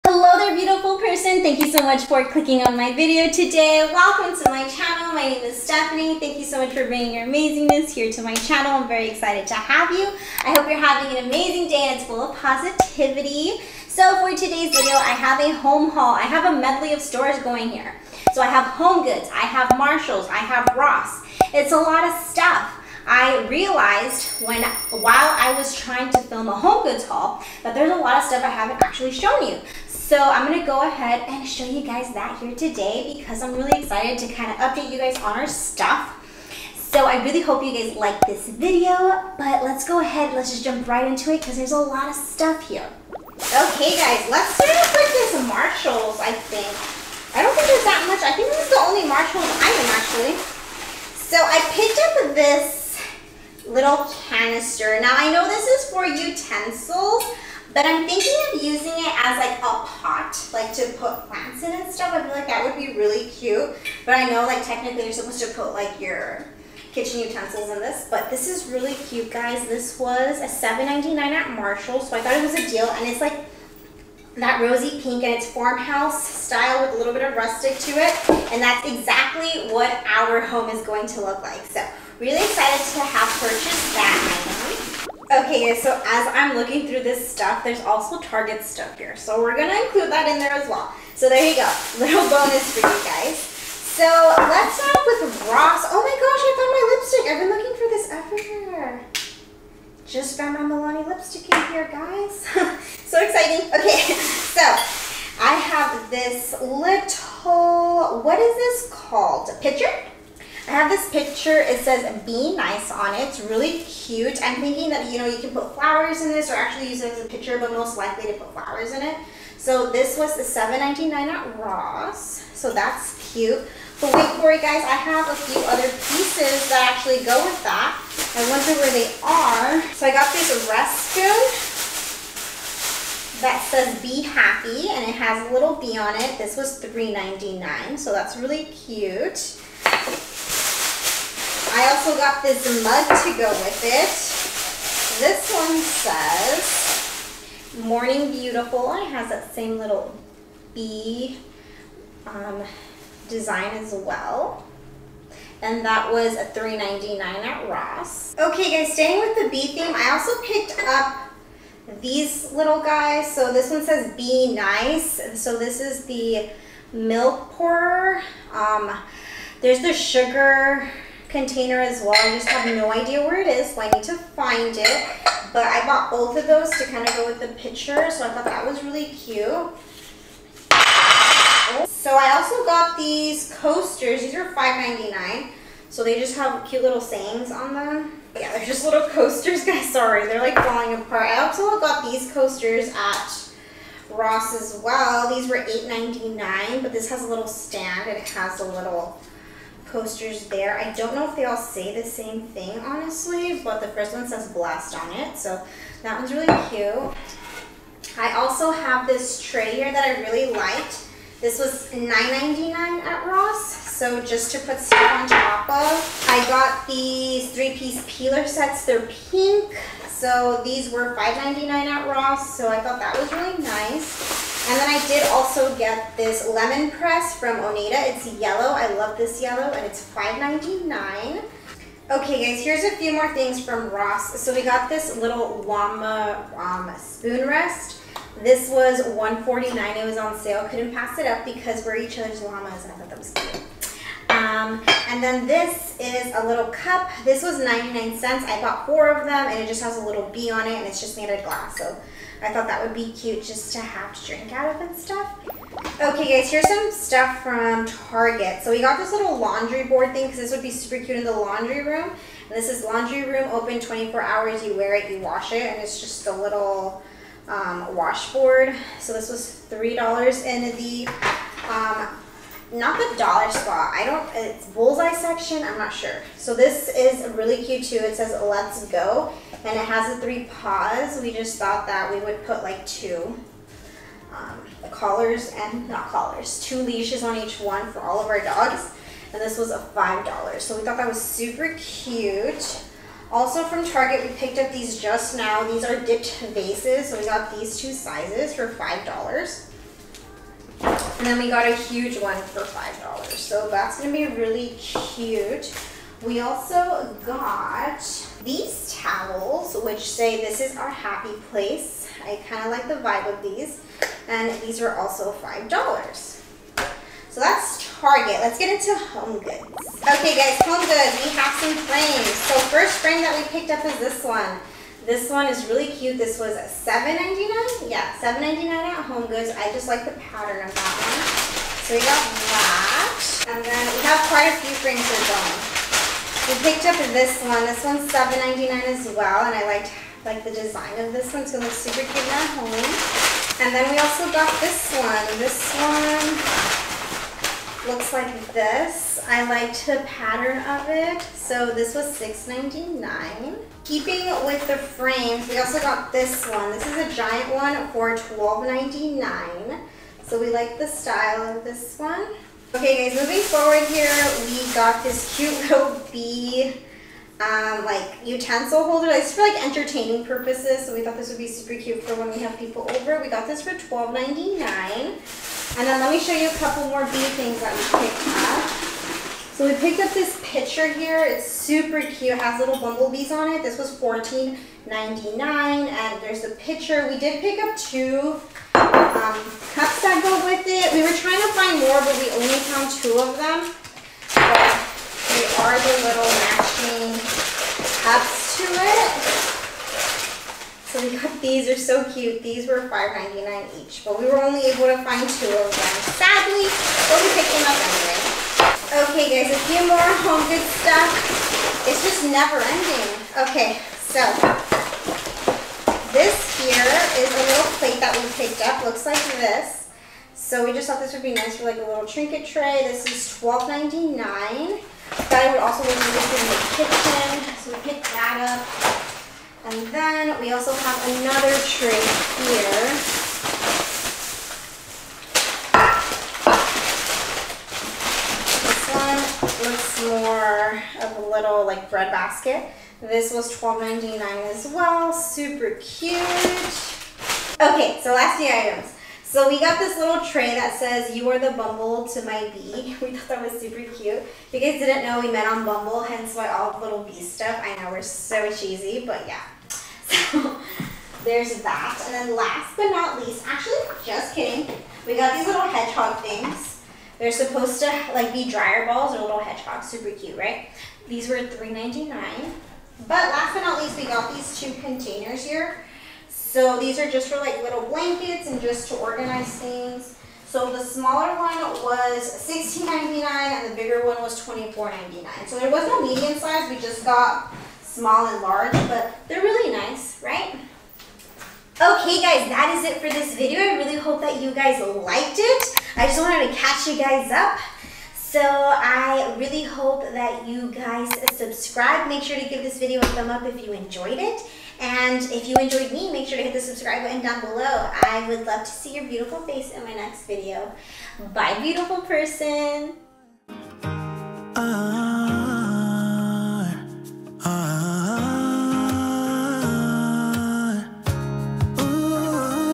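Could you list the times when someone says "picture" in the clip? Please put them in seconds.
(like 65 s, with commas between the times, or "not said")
111 s, 117 s, 177 s.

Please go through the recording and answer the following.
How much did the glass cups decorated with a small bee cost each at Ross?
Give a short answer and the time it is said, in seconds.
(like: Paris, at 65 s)
99 cents, at 247 s.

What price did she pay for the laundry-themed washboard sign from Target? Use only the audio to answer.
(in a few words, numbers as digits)
$3.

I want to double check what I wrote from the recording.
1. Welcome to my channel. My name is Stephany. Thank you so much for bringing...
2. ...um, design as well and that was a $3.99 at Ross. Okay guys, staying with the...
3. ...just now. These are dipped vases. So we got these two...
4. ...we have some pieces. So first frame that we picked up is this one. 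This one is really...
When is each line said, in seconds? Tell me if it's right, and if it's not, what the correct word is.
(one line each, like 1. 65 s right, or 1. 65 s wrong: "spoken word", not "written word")
1. 3 s right
2. 152 s right
3. 295 s right
4. 321 s wrong: "frames", not "pieces".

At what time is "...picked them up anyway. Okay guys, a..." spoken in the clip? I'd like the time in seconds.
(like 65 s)
407 s.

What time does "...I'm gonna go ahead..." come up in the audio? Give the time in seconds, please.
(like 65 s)
30 s.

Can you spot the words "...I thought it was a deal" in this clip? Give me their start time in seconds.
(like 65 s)
72 s.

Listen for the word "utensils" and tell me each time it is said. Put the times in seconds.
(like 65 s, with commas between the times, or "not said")
56 s, 67 s, 368 s.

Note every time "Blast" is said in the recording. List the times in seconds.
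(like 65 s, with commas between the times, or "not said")
204 s.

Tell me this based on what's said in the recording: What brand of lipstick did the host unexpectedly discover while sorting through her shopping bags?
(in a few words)
Milani.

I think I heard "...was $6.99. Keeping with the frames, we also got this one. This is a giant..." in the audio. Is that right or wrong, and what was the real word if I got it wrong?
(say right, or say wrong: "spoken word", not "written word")
right.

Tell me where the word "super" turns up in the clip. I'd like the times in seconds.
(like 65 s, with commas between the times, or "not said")
260 s, 291 s, 341 s, 371 s, 381 s, 445 s, 453 s, 469 s.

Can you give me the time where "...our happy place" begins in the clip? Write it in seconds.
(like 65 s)
310 s.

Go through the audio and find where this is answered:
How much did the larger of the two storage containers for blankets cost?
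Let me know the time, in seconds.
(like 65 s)
484 s.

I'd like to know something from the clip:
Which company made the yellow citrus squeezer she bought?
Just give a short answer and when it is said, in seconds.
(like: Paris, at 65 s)
Oneida, at 227 s.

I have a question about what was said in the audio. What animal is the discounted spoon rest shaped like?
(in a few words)
llama.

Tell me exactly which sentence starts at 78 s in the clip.
And that's exactly what our home is going to look like.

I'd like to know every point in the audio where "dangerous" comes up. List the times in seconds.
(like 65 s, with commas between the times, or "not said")
not said.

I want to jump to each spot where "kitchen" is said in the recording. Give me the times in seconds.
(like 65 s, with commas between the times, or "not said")
66 s, 427 s.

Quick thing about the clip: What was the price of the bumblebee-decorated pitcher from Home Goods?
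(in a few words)
$14.99.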